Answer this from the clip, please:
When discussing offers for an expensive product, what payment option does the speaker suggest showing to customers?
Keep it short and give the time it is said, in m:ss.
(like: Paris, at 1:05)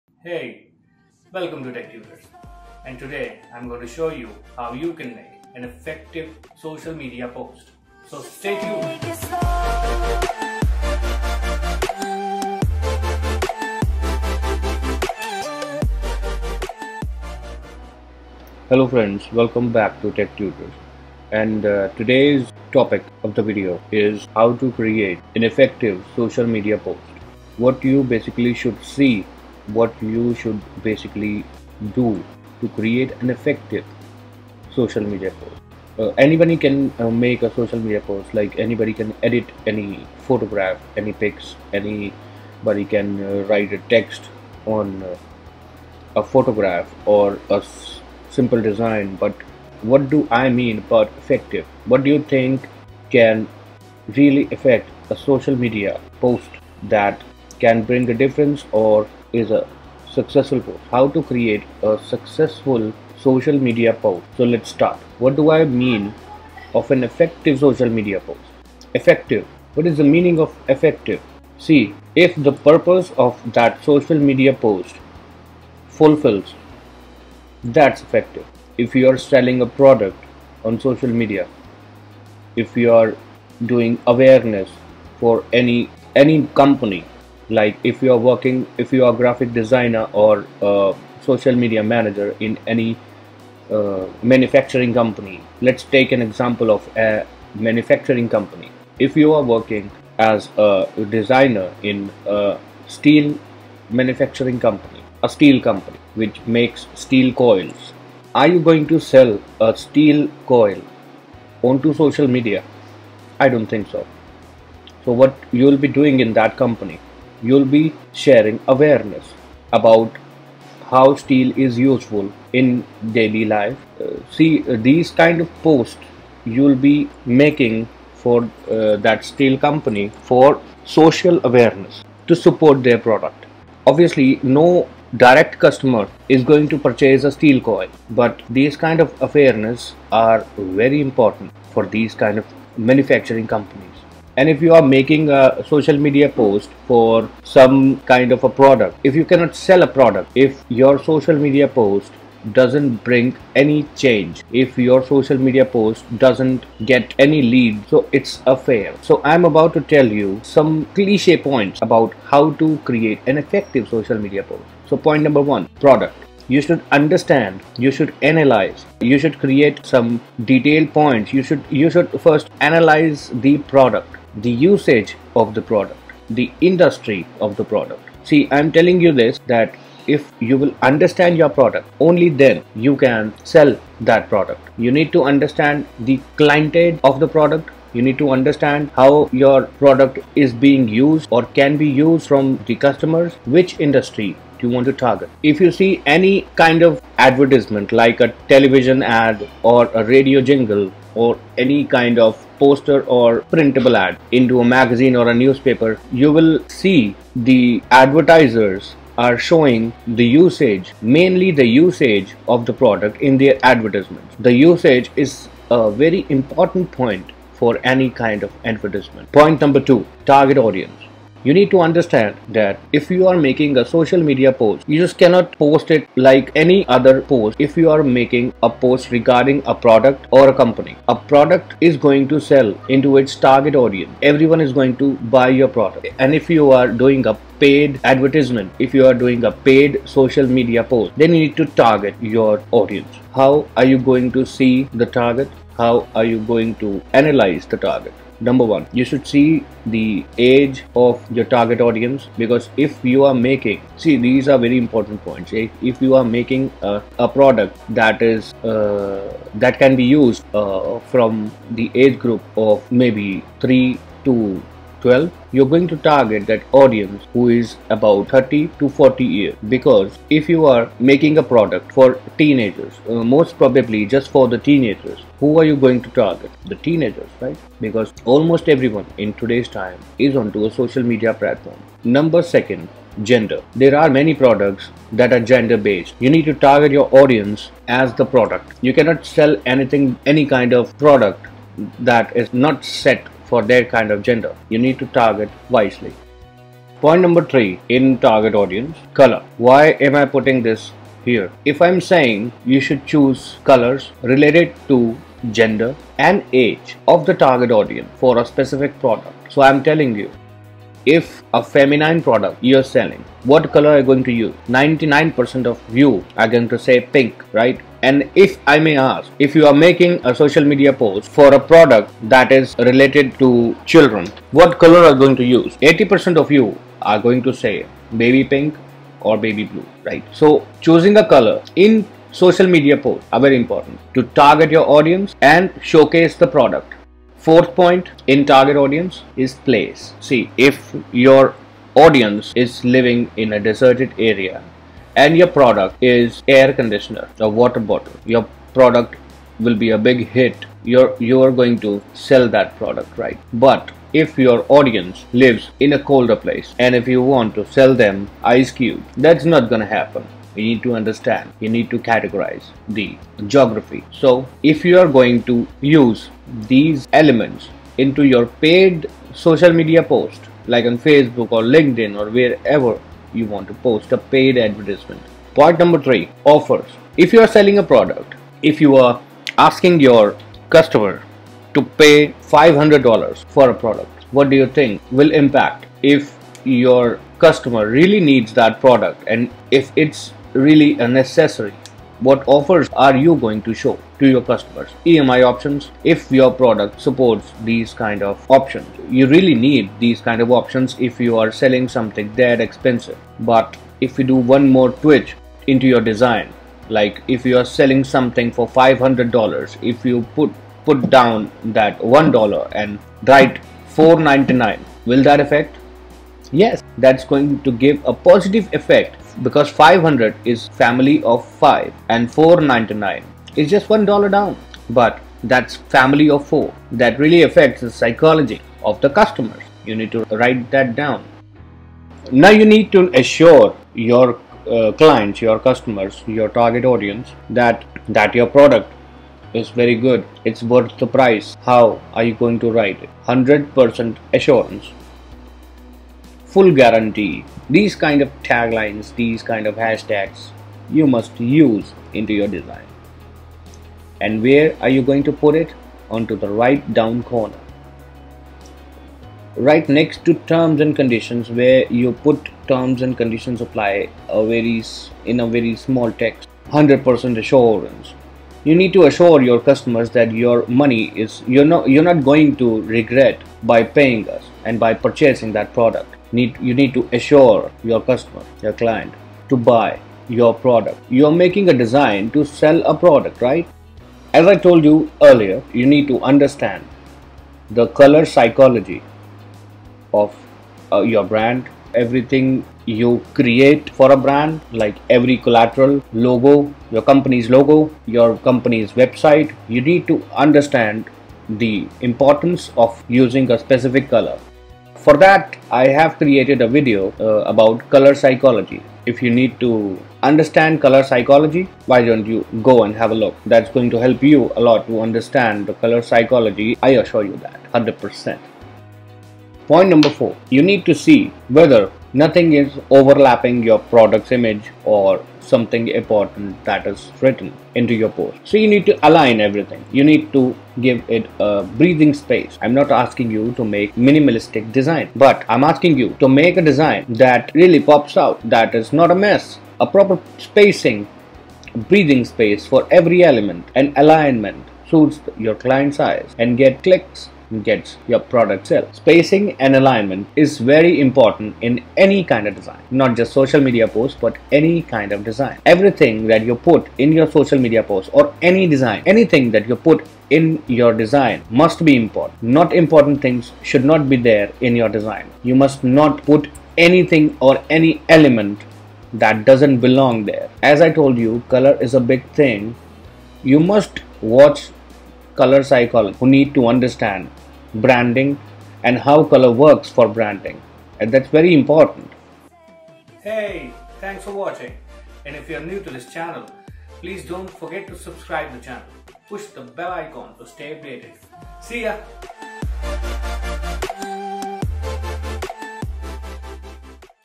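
EMI options, at 6:35.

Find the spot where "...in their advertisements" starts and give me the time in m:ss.
3:33.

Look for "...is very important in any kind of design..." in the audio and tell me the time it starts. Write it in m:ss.
9:10.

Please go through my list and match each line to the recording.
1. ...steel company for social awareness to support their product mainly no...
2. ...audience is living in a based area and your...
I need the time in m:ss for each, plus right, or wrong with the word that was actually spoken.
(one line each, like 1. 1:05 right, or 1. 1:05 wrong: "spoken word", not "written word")
1. 2:09 wrong: "obviously", not "mainly"
2. 5:41 wrong: "deserted", not "based".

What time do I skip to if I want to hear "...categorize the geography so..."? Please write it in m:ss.
6:01.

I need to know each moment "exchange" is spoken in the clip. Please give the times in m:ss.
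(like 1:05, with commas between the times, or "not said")
not said.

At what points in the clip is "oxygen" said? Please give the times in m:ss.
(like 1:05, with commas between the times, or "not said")
not said.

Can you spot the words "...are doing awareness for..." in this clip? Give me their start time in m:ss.
1:22.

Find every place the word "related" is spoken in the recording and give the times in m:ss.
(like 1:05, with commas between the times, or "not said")
5:04, 5:22.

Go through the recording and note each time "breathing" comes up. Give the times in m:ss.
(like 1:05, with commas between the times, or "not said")
8:51, 9:01.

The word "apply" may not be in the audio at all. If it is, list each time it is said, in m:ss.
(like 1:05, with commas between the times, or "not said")
7:43.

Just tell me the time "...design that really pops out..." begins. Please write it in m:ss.
8:56.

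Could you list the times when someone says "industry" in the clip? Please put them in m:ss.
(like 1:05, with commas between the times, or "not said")
2:56, 3:13.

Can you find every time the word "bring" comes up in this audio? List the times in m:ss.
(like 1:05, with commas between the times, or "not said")
0:57, 2:33.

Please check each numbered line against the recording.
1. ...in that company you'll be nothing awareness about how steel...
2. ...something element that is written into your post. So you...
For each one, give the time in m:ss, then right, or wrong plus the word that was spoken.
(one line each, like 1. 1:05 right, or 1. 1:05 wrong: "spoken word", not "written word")
1. 1:56 wrong: "sharing", not "nothing"
2. 8:45 wrong: "important", not "element".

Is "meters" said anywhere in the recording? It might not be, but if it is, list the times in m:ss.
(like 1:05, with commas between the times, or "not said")
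not said.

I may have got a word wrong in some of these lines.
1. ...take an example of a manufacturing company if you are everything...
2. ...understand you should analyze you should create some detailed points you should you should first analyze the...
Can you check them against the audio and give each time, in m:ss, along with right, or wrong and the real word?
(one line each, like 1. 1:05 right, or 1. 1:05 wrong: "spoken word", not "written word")
1. 1:35 wrong: "working", not "everything"
2. 2:46 right.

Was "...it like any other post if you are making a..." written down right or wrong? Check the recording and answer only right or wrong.
right.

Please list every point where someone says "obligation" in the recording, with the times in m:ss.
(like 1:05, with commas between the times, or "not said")
not said.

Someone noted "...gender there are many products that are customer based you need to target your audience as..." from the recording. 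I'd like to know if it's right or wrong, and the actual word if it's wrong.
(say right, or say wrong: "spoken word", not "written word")
wrong: "gender", not "customer".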